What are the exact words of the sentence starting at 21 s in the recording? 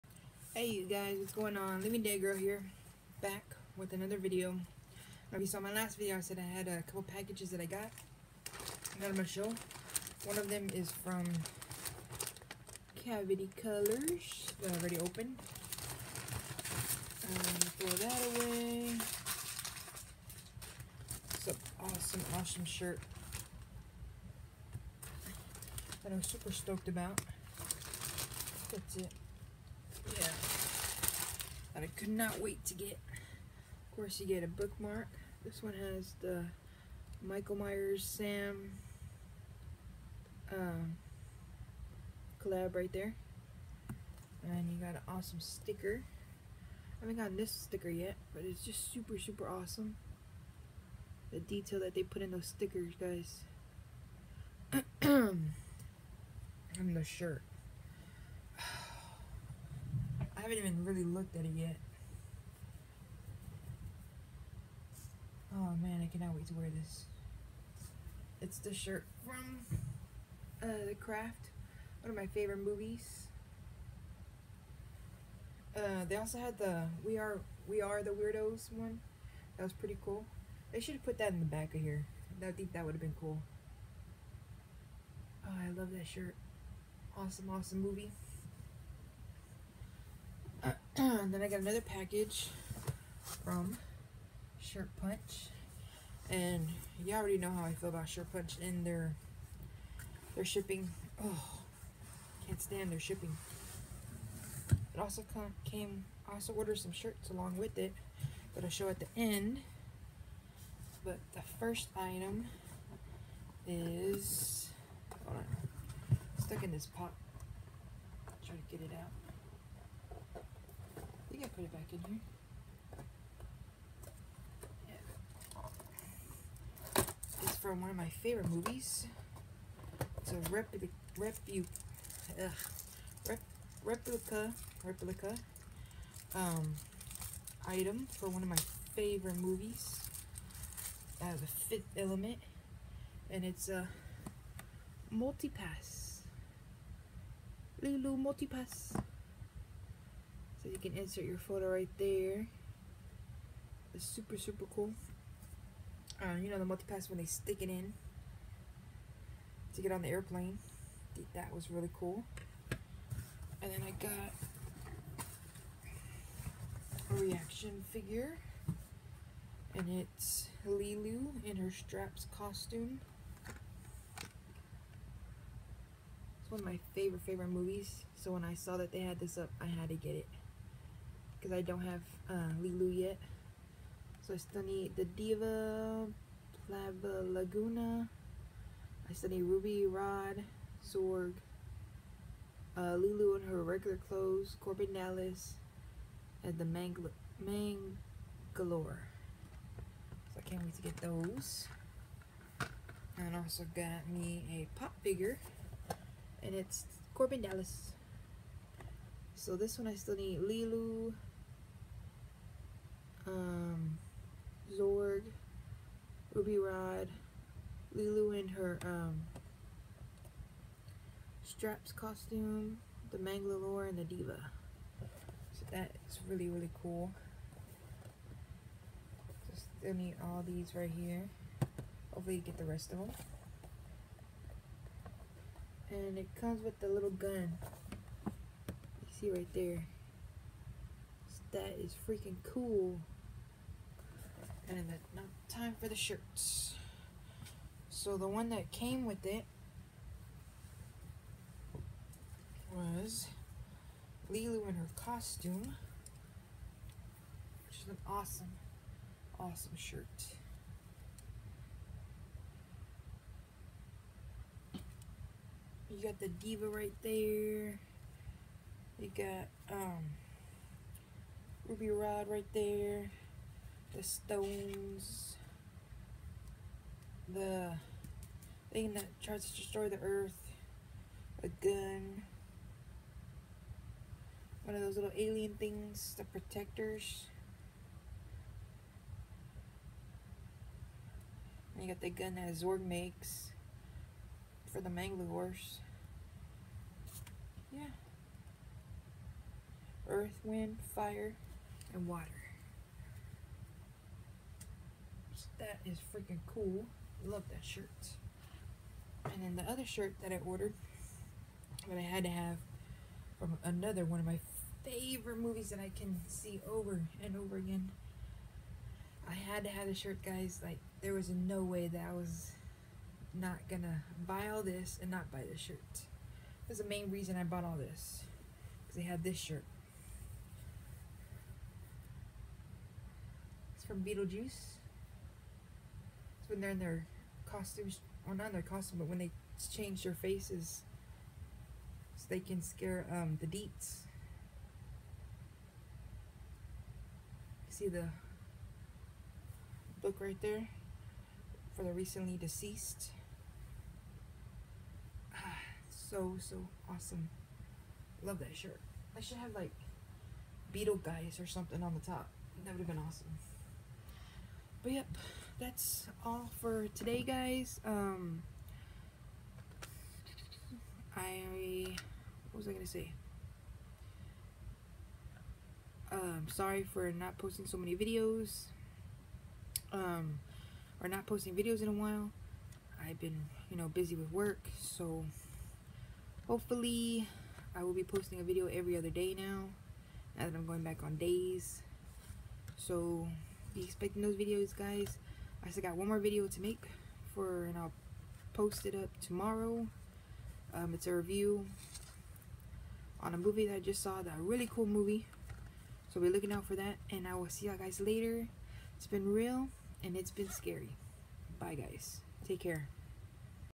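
It's an awesome, awesome shirt that I'm super stoked about.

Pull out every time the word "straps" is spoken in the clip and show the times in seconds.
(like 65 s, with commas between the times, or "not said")
171 s, 221 s.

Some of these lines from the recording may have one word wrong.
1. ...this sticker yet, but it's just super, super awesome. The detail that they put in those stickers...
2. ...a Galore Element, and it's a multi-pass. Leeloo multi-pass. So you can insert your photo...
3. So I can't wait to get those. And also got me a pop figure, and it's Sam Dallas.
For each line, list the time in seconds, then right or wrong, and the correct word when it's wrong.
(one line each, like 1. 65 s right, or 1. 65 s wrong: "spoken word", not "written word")
1. 47 s right
2. 141 s wrong: "Fifth", not "Galore"
3. 200 s wrong: "Korben", not "Sam".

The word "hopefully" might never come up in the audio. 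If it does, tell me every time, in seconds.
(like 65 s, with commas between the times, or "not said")
232 s, 386 s.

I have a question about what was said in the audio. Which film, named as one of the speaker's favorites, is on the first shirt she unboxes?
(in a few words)
The Craft.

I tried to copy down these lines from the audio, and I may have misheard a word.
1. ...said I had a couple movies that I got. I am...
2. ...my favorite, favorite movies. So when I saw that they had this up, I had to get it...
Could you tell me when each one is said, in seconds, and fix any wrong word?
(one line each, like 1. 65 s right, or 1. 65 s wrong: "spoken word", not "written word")
1. 6 s wrong: "packages", not "movies"
2. 176 s right.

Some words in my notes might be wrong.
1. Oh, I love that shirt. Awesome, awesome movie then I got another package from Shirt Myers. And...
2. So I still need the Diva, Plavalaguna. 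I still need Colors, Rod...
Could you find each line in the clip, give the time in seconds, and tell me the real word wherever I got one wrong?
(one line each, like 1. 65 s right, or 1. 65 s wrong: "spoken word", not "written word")
1. 85 s wrong: "Punch", not "Myers"
2. 184 s wrong: "Ruby", not "Colors".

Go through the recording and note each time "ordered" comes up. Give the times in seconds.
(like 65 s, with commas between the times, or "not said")
106 s, 310 s.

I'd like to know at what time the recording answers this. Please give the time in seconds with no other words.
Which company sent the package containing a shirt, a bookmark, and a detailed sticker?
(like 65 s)
13 s.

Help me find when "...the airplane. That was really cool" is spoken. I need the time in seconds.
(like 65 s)
160 s.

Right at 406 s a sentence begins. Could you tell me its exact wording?
So be looking out for that, and I will see y'all guys later.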